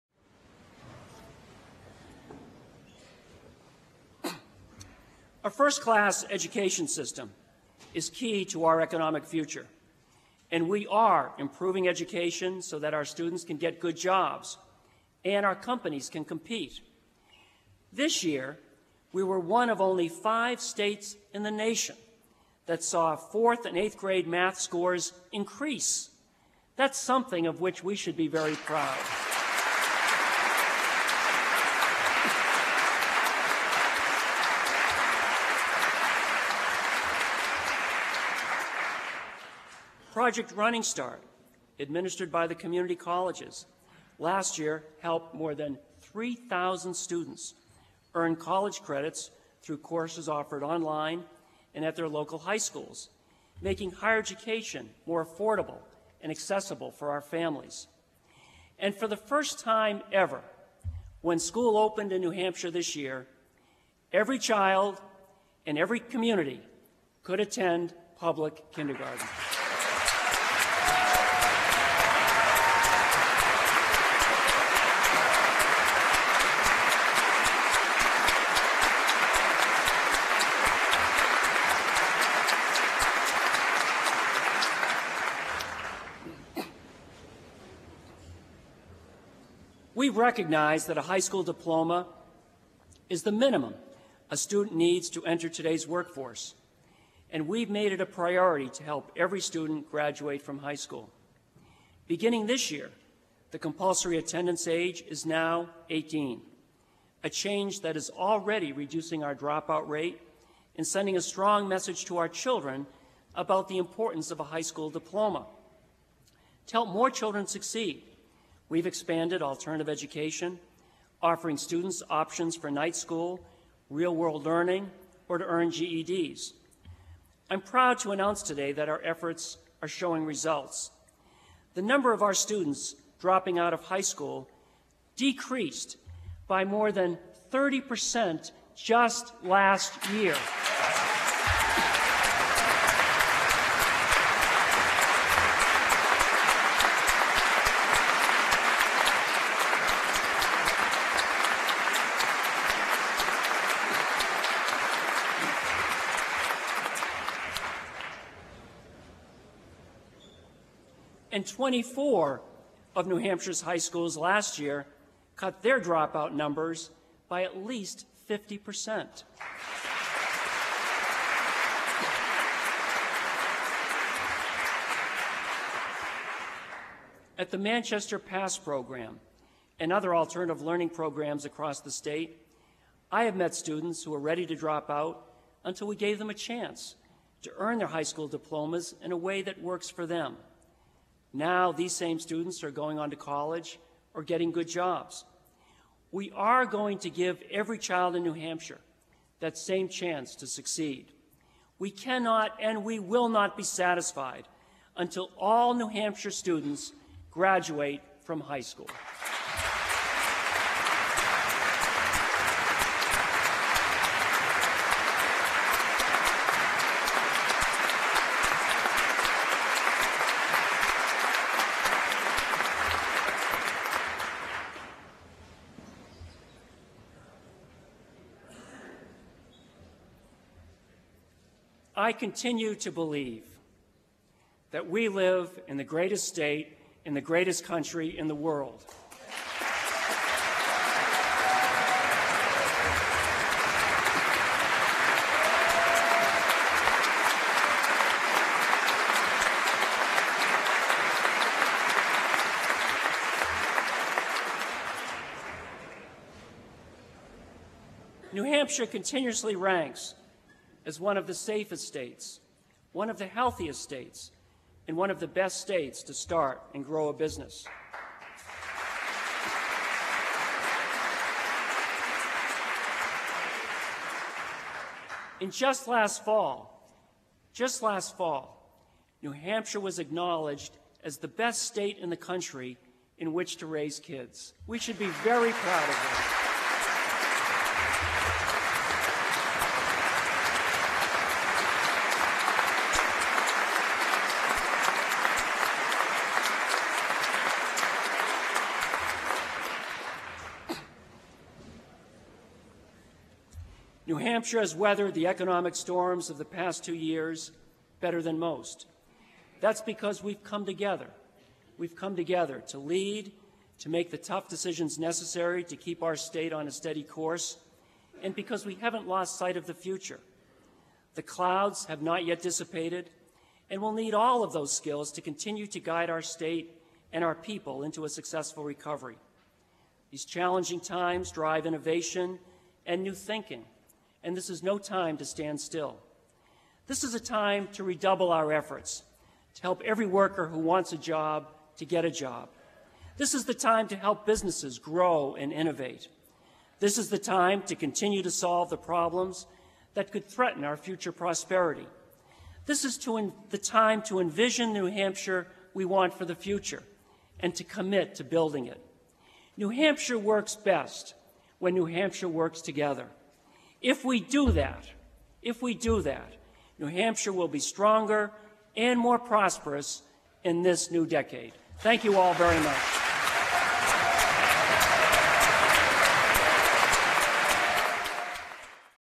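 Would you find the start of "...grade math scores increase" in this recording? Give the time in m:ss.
0:23.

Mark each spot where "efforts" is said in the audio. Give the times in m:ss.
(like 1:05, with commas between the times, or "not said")
2:09, 5:38.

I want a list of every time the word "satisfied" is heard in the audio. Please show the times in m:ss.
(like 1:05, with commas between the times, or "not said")
3:23.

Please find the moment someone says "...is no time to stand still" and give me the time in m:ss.
5:34.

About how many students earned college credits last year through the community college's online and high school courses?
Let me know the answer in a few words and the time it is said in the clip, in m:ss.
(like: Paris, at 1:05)
3,000, at 0:46.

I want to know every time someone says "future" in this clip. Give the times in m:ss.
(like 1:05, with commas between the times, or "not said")
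0:09, 5:19, 5:50, 5:56.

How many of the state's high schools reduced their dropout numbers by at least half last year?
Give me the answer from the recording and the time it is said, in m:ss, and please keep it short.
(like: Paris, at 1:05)
24, at 2:41.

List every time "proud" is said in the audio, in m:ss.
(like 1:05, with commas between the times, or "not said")
0:28, 2:07, 4:45.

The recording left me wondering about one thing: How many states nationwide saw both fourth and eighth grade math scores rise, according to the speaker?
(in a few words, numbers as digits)
5.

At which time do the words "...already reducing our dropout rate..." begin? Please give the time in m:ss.
1:48.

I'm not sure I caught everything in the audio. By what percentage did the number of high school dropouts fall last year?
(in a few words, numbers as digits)
30%.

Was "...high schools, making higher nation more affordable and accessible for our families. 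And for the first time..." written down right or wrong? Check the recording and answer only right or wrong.
wrong.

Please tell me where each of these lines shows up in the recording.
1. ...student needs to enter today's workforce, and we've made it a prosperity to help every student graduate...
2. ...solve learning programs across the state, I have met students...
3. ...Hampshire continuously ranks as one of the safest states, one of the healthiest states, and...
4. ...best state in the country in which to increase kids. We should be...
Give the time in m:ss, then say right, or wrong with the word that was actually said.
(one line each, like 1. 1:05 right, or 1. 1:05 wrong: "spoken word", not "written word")
1. 1:34 wrong: "priority", not "prosperity"
2. 3:00 wrong: "alternative", not "solve"
3. 4:18 right
4. 4:41 wrong: "raise", not "increase".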